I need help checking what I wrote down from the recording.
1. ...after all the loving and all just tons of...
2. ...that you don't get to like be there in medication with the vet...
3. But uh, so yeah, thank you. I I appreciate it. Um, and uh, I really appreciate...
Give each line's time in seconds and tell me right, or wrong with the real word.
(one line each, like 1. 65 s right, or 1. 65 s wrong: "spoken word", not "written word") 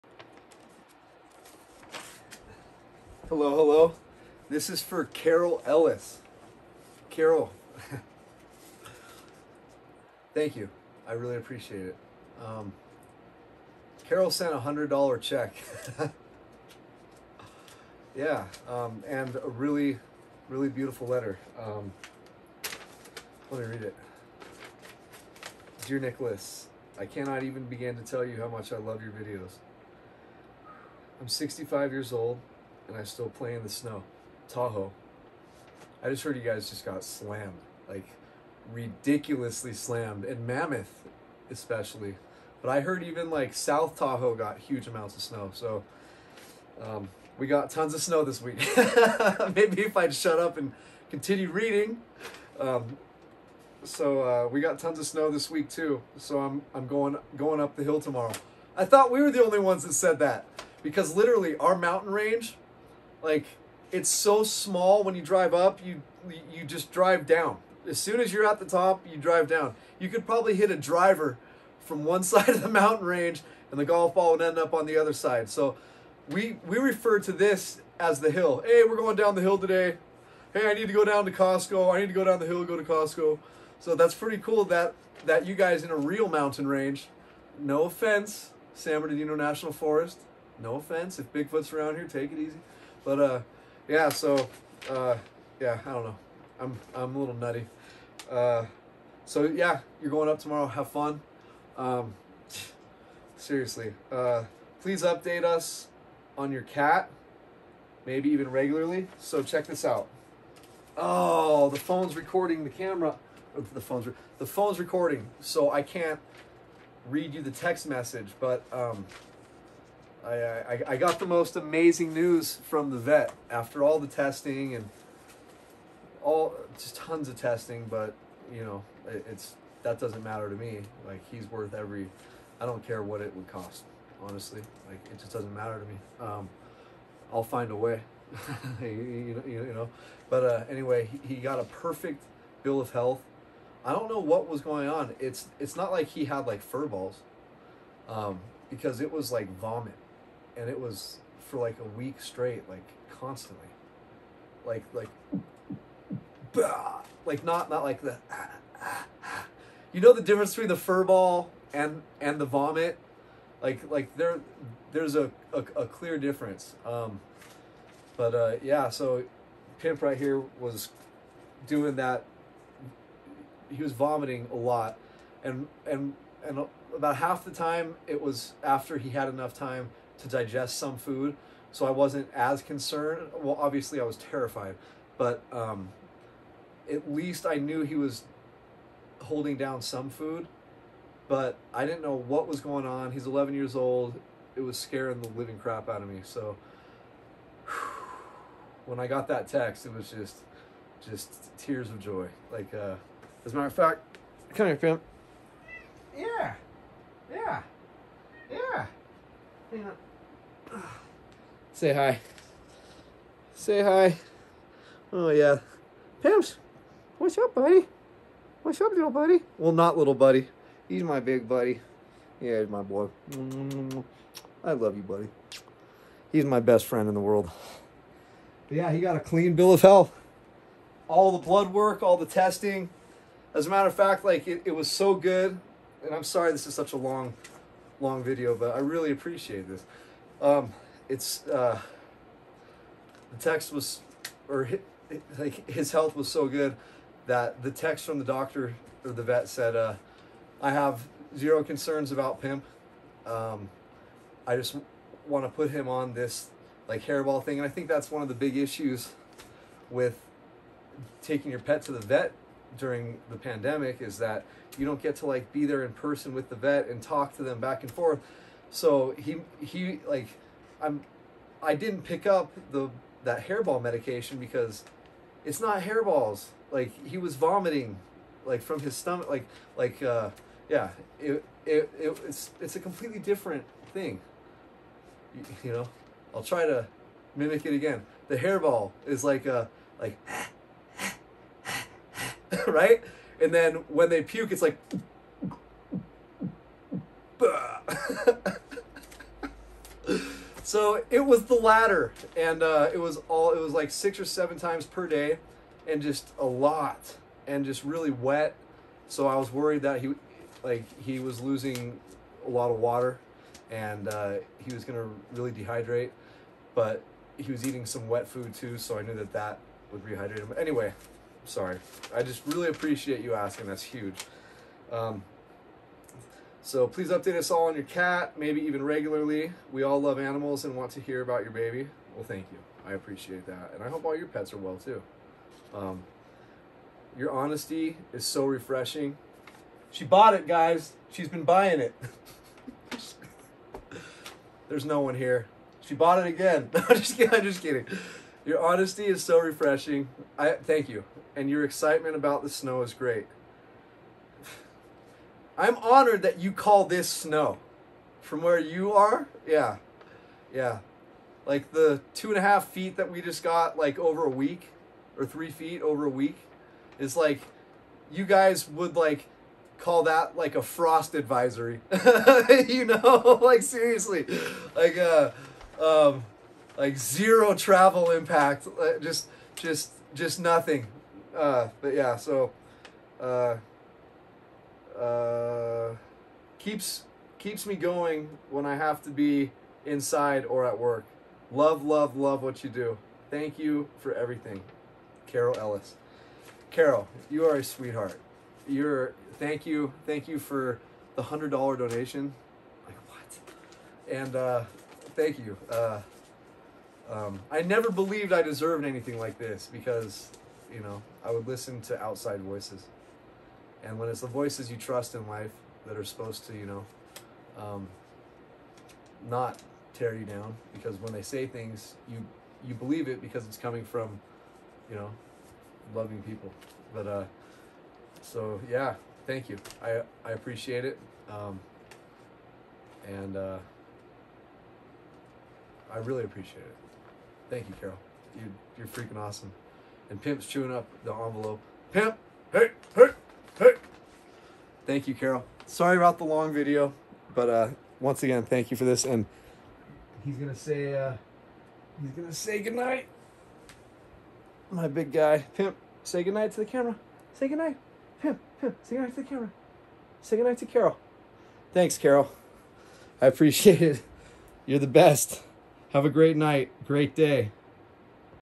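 1. 123 s wrong: "testing", not "loving"
2. 264 s wrong: "person", not "medication"
3. 426 s right.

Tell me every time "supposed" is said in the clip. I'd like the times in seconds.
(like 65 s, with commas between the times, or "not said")
416 s.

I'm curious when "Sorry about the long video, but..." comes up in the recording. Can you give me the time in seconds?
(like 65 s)
445 s.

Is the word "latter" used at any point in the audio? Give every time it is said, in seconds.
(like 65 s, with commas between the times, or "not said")
301 s.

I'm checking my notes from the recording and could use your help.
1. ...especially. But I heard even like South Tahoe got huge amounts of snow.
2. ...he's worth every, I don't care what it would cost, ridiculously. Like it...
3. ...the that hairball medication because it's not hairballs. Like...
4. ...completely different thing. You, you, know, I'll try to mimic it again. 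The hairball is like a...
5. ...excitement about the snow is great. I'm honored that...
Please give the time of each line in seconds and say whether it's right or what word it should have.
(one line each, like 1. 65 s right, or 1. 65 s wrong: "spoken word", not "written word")
1. 41 s right
2. 131 s wrong: "honestly", not "ridiculously"
3. 272 s right
4. 282 s right
5. 351 s right.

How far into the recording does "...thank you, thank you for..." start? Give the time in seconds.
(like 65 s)
399 s.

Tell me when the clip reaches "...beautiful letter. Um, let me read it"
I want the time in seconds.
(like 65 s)
20 s.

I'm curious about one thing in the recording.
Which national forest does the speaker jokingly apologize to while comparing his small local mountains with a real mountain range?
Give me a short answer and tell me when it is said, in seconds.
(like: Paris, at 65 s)
San Bernardino National Forest, at 88 s.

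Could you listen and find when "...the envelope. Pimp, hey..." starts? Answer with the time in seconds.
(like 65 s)
441 s.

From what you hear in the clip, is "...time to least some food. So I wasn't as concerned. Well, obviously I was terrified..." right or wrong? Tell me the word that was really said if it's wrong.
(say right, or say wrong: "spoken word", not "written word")
wrong: "digest", not "least".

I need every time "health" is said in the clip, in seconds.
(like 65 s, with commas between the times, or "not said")
142 s, 229 s, 245 s.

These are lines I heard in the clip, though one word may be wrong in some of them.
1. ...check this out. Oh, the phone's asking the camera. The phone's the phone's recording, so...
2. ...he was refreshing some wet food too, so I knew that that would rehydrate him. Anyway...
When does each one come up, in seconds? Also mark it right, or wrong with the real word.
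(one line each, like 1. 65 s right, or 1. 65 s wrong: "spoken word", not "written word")
1. 109 s wrong: "recording", not "asking"
2. 317 s wrong: "eating", not "refreshing".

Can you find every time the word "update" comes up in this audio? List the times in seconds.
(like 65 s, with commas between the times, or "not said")
105 s, 327 s.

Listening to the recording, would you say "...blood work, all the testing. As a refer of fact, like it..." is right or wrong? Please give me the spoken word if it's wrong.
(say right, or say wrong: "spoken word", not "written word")
wrong: "matter", not "refer".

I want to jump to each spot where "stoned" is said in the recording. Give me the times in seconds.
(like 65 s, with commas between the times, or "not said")
not said.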